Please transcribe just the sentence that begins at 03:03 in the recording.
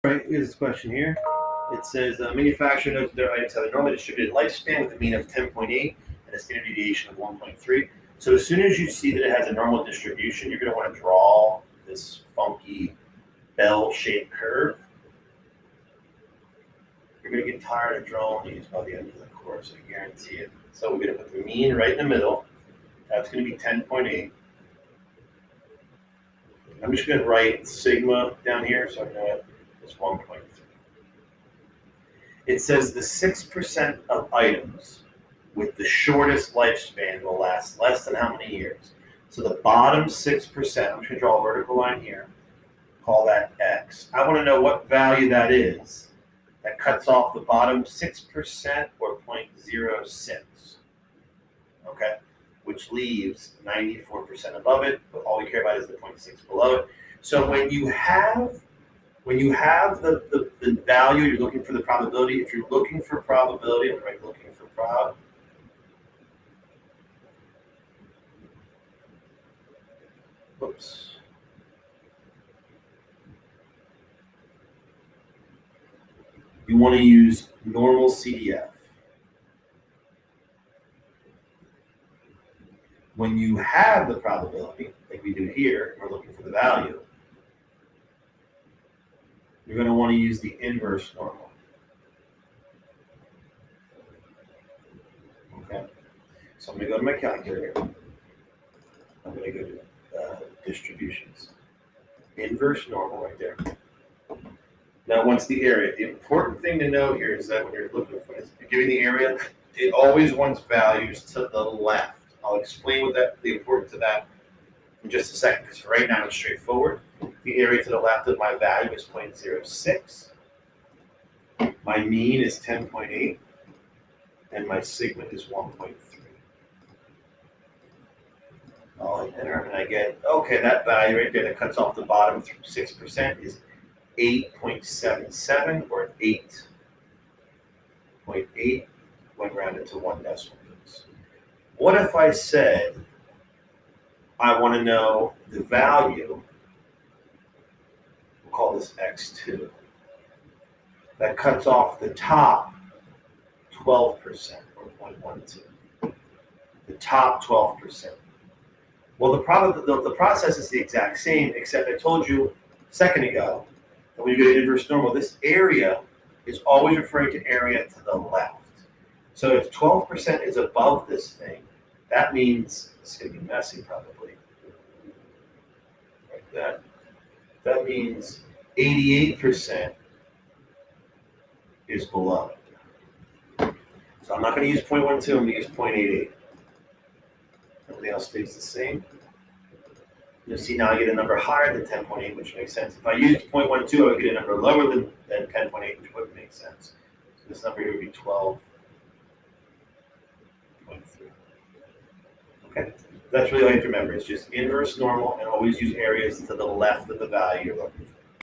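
So I'm not going to use 0.12, I'm going to use 0.88.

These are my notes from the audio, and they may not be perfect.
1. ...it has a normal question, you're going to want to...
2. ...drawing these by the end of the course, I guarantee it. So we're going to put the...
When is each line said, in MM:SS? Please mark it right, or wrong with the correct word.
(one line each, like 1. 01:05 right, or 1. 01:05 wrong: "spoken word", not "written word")
1. 00:09 wrong: "distribution", not "question"
2. 00:18 right.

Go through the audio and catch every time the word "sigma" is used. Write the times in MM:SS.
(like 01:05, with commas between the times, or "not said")
00:27, 02:04.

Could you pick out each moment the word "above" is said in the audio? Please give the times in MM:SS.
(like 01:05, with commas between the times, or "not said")
00:54, 02:50.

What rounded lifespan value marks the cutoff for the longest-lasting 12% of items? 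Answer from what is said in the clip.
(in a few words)
12.3.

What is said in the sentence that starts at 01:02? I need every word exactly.
If you're looking for probability, I'm right looking for prob.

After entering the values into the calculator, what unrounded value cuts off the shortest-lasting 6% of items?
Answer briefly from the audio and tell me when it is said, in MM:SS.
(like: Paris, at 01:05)
8.77, at 02:14.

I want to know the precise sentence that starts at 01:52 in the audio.
I'll explain what that the importance of that in just a second, because right now it's straightforward.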